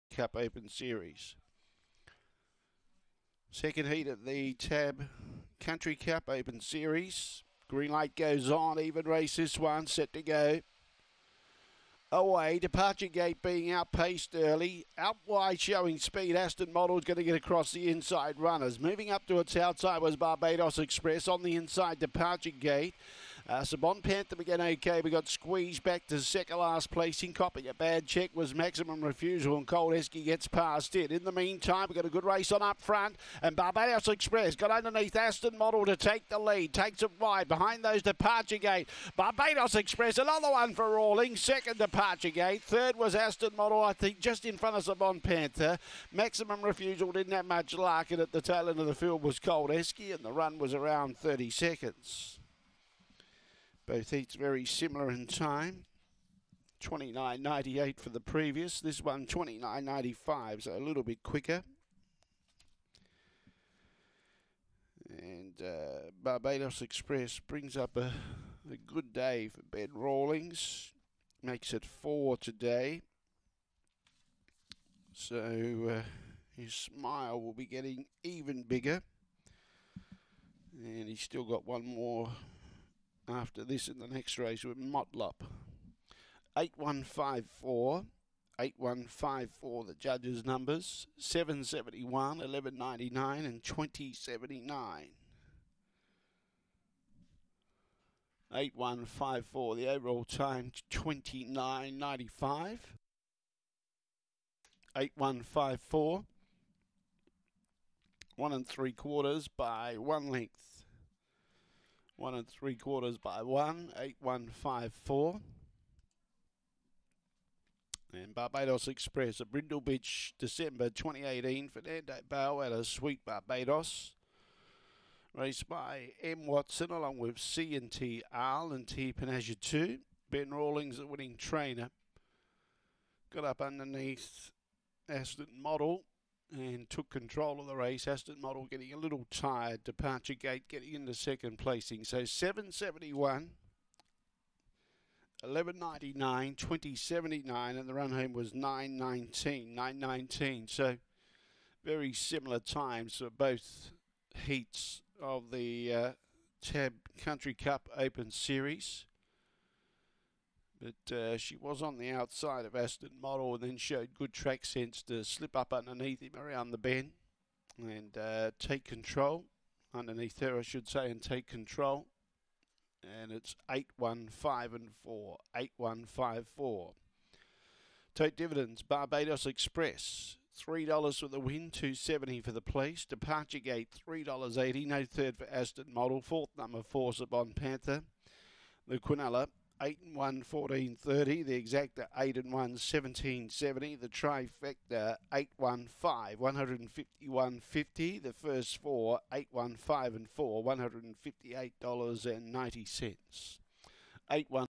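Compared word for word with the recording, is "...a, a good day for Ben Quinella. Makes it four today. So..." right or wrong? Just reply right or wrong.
wrong.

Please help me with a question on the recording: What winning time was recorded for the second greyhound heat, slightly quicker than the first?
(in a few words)
29.95.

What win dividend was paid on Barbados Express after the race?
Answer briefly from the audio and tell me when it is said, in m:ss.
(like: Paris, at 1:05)
$3, at 3:00.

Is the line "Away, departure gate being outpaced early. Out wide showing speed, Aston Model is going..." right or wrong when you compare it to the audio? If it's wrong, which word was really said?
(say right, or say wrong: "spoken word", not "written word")
right.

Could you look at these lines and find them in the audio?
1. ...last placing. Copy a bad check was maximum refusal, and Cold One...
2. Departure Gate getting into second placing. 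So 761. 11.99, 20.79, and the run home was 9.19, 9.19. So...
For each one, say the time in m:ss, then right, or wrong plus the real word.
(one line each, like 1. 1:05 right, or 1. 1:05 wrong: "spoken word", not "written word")
1. 0:26 wrong: "Esky", not "One"
2. 2:19 wrong: "771", not "761".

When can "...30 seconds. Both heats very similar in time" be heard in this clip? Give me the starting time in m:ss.
0:51.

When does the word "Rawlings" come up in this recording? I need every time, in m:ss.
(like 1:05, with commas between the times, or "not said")
0:40, 1:09, 2:10.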